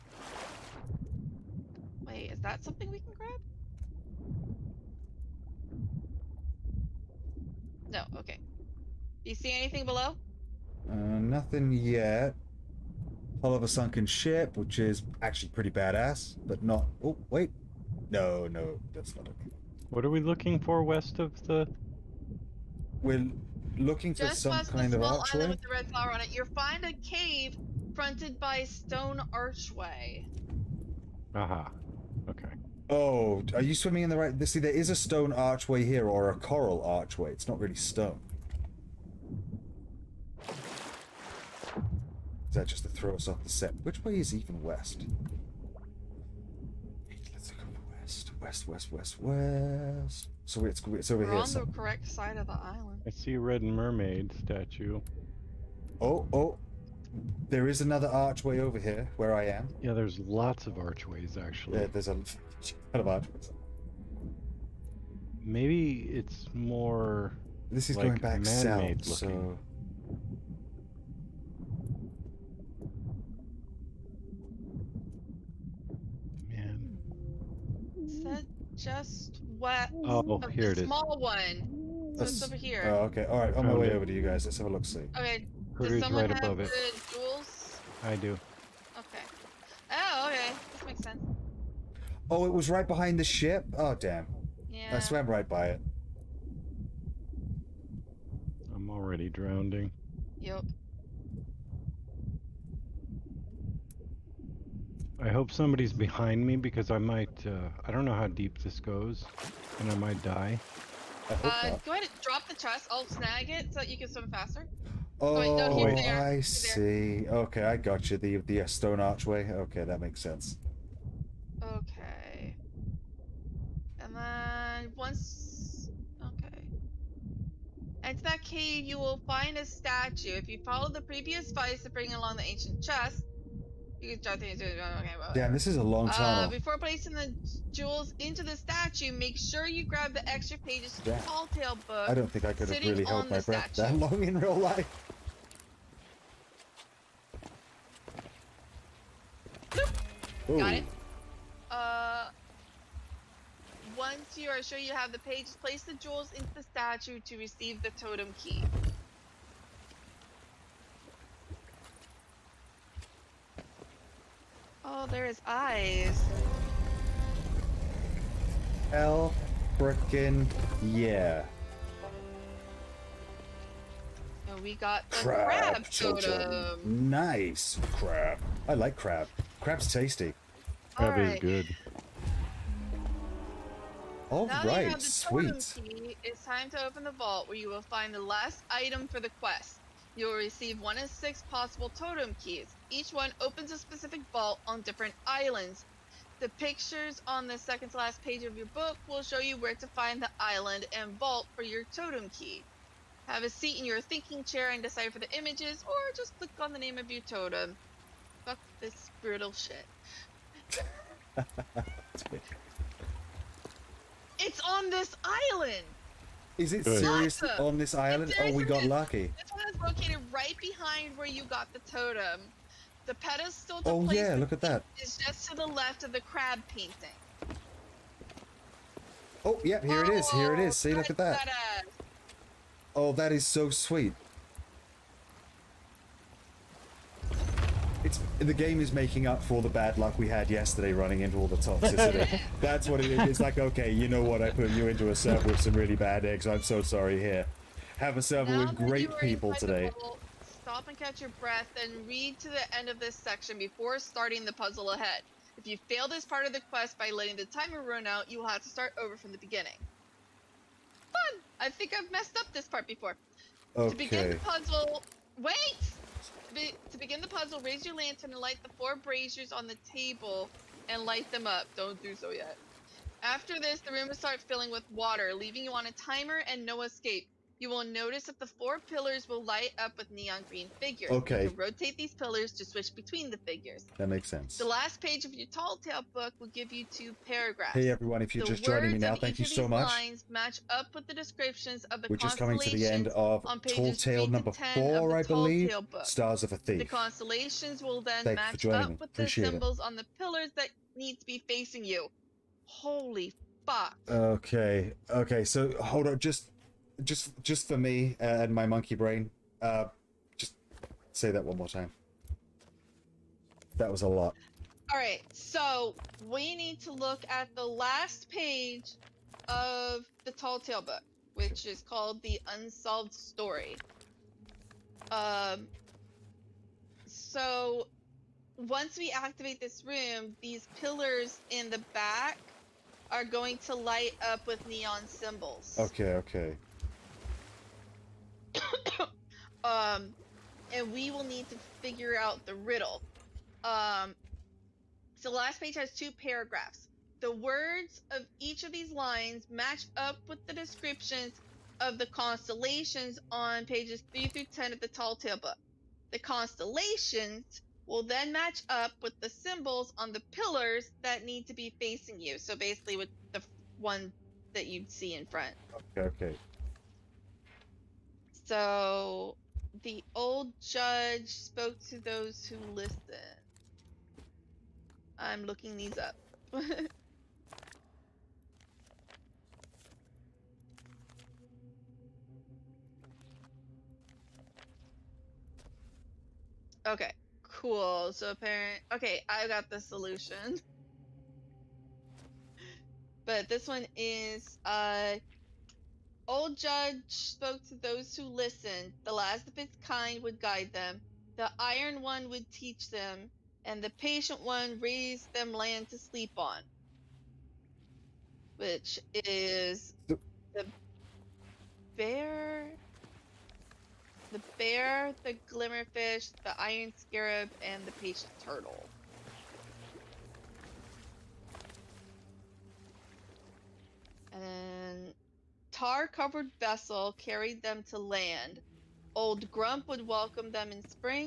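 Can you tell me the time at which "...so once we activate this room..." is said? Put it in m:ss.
5:27.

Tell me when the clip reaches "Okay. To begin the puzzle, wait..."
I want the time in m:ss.
4:23.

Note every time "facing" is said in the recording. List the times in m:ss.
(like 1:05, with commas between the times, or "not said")
5:01, 6:01.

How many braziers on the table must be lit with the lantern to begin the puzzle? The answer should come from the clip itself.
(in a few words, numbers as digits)
4.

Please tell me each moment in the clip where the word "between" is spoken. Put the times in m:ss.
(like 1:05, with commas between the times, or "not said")
4:42.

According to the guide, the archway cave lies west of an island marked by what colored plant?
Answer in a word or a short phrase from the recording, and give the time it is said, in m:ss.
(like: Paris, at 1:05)
red flower, at 0:25.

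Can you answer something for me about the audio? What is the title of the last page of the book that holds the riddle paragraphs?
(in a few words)
The Unsolved Story.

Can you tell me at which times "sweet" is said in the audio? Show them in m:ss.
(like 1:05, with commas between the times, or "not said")
3:04, 3:53.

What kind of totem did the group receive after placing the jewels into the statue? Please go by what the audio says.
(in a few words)
crab totem.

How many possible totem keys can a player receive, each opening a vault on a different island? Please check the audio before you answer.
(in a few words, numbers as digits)
6.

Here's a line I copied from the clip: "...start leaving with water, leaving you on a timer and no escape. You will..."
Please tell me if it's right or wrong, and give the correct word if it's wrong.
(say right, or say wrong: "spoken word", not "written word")
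wrong: "filling", not "leaving".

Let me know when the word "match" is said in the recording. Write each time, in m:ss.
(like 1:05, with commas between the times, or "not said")
4:50, 4:58, 5:49, 5:58.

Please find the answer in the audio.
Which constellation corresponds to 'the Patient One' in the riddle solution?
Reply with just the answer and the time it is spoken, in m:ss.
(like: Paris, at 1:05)
patient turtle, at 6:57.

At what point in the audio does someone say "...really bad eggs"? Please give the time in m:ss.
4:05.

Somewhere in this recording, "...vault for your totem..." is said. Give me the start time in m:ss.
3:21.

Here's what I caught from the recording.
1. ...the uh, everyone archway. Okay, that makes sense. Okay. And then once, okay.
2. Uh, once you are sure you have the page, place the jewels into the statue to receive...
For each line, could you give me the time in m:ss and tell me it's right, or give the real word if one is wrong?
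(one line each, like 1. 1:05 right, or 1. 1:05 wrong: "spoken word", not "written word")
1. 1:58 wrong: "stone", not "everyone"
2. 2:31 right.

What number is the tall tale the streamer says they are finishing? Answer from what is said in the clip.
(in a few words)
4.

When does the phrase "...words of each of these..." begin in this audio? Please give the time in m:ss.
5:47.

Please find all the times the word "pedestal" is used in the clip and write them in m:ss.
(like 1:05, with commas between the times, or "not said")
3:43.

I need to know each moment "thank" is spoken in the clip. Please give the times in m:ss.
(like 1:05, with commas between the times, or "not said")
4:49, 4:58.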